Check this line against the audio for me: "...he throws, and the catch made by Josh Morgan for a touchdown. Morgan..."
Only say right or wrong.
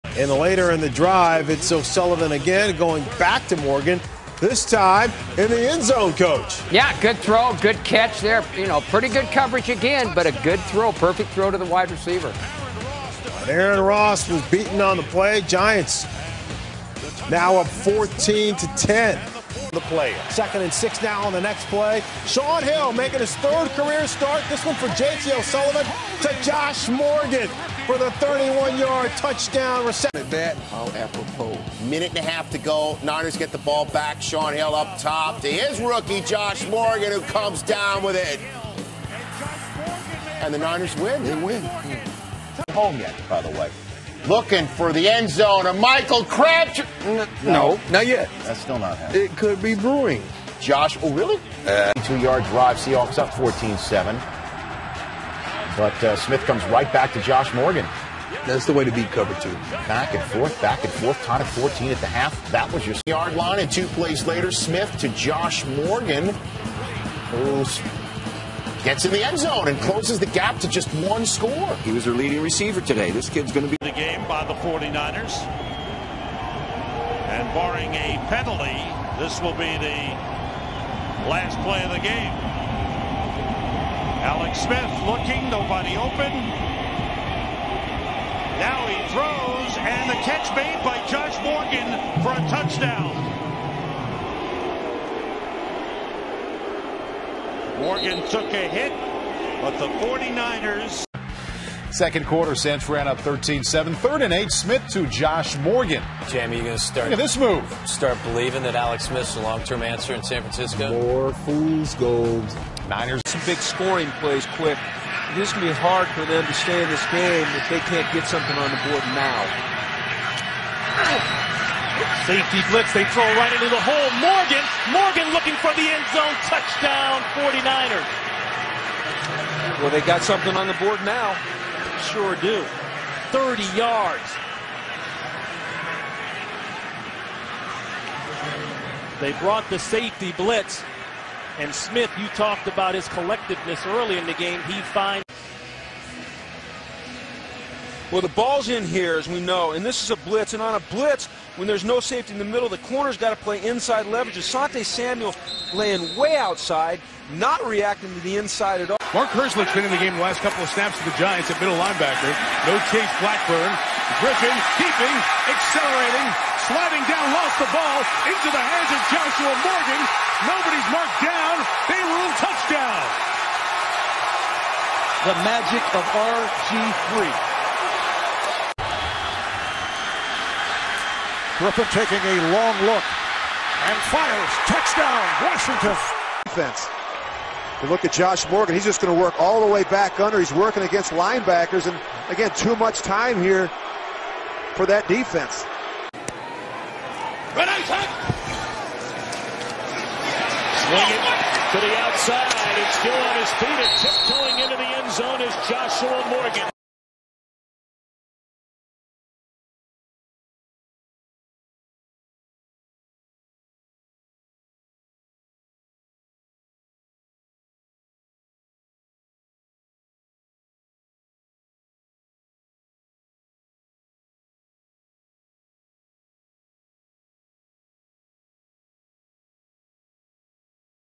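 right.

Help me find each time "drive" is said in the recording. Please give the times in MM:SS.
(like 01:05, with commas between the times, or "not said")
00:00, 00:52.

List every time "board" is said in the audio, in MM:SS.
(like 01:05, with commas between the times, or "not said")
01:58, 02:10.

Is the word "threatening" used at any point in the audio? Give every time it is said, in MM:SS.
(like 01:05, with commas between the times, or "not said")
not said.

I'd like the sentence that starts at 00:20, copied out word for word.
Second and six now on the next play.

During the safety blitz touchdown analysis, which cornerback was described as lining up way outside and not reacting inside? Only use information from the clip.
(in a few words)
Asante Samuel.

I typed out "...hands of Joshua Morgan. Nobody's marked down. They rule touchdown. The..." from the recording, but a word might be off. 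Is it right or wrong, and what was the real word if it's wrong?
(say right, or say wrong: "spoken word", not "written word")
right.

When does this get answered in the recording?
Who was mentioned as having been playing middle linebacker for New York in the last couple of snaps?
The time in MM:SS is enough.
02:39.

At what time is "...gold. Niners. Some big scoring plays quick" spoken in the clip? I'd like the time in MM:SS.
01:51.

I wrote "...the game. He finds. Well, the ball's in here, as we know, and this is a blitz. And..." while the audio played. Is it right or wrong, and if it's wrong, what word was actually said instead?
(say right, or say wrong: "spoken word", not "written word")
right.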